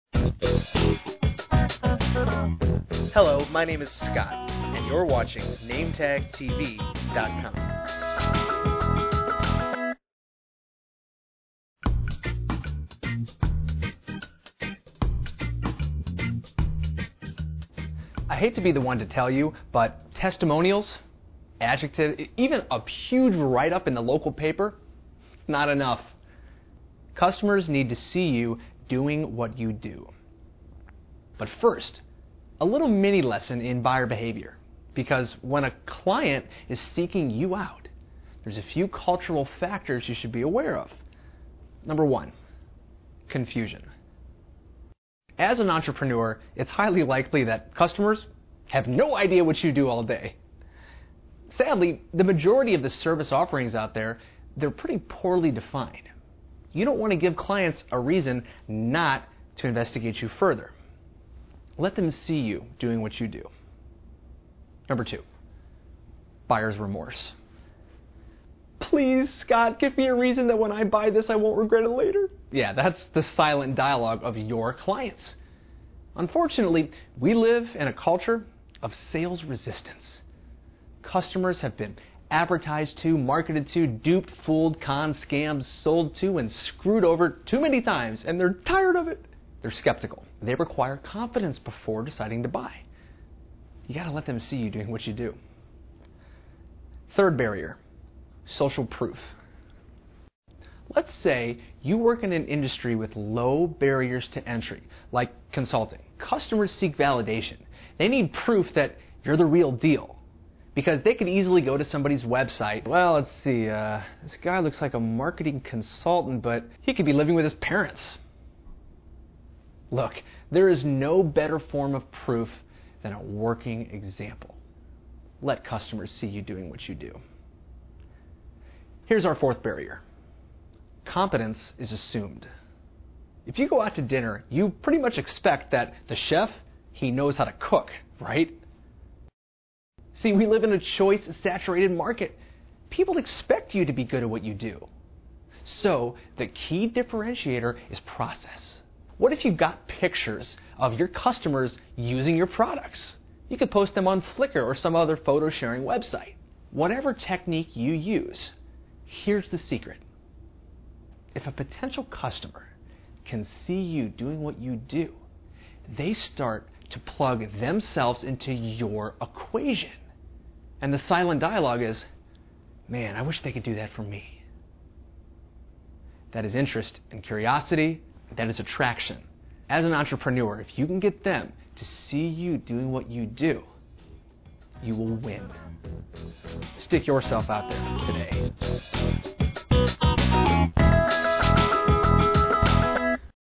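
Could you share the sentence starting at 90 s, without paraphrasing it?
They require confidence before deciding to buy.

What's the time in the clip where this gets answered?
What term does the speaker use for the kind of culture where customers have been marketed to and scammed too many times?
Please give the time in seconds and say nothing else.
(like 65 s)
78 s.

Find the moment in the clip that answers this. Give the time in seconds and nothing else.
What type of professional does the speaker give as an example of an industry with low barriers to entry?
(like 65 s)
105 s.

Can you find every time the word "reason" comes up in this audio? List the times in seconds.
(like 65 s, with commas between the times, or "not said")
57 s, 70 s.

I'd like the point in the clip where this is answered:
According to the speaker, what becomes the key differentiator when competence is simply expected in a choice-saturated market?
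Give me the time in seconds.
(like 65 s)
148 s.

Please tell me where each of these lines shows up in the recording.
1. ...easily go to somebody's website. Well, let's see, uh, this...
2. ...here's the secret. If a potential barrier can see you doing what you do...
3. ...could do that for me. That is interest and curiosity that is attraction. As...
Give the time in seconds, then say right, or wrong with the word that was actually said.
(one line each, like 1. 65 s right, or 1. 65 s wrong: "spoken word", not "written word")
1. 111 s right
2. 159 s wrong: "customer", not "barrier"
3. 173 s right.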